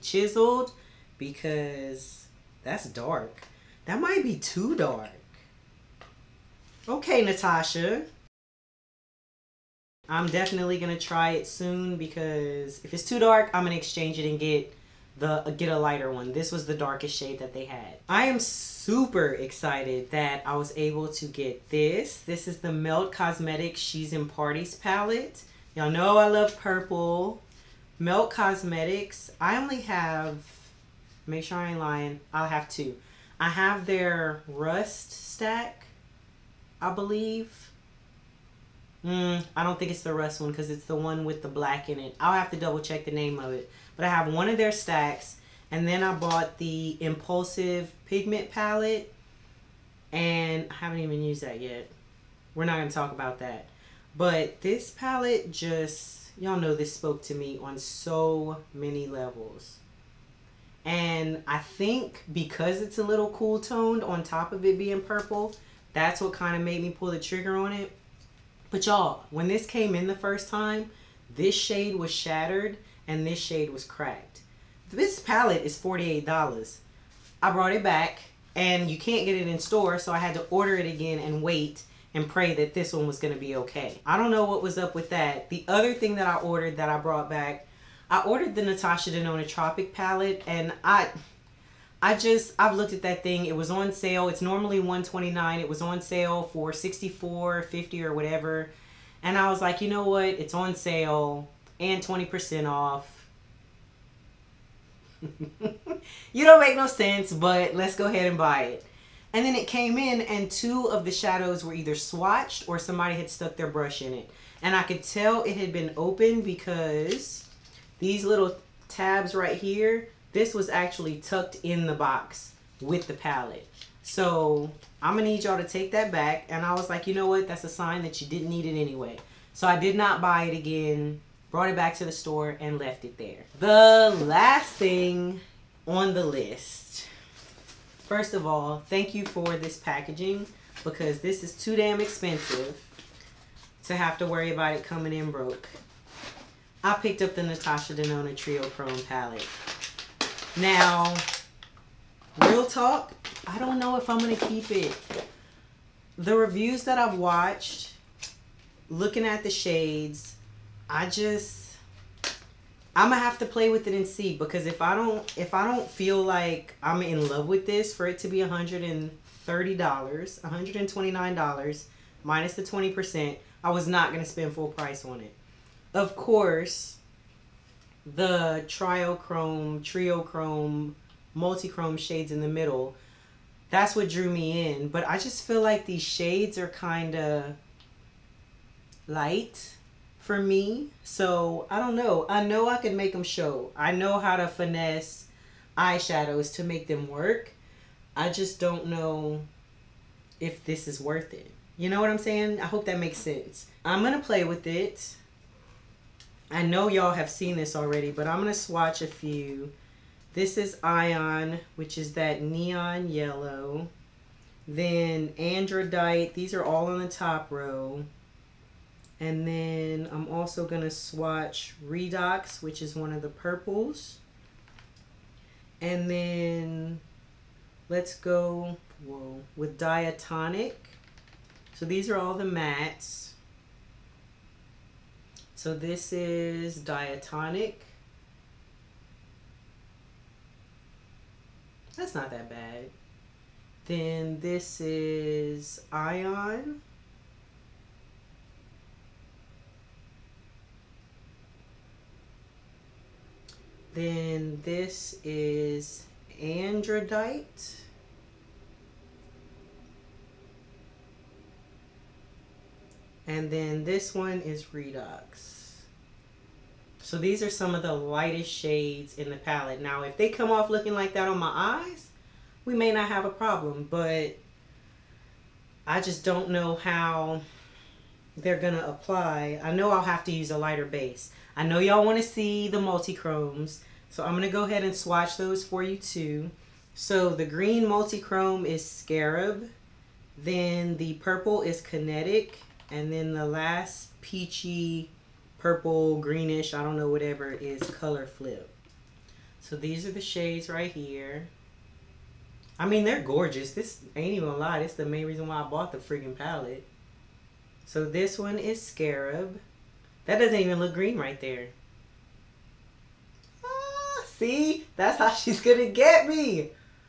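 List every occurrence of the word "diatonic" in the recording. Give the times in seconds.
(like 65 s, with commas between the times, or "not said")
229 s, 236 s.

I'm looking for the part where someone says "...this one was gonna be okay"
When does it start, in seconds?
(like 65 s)
82 s.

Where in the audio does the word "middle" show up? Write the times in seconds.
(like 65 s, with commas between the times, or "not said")
182 s.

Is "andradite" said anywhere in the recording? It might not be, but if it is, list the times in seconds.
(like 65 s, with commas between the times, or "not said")
215 s, 256 s.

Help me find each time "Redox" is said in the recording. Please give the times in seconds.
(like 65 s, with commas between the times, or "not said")
221 s, 264 s.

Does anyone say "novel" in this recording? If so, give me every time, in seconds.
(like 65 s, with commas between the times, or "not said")
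not said.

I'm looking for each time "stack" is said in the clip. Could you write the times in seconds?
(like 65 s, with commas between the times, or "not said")
35 s, 44 s.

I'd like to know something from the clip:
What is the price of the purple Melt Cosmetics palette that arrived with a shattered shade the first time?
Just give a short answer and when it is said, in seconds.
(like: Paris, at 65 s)
$48, at 75 s.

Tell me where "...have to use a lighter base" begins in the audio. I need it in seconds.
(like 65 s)
280 s.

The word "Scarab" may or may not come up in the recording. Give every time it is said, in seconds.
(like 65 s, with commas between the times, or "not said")
288 s, 308 s.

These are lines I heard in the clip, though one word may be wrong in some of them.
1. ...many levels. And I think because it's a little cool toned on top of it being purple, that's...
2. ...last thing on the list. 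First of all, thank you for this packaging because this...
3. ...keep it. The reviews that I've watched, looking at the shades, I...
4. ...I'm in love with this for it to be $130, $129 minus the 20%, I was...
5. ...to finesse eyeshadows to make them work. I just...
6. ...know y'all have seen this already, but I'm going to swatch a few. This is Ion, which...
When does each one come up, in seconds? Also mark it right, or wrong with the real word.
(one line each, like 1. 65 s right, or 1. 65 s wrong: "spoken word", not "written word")
1. 58 s right
2. 134 s right
3. 154 s right
4. 166 s right
5. 194 s right
6. 206 s right.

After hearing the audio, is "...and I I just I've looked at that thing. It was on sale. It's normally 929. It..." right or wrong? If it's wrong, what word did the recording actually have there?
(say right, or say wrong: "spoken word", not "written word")
wrong: "129", not "929".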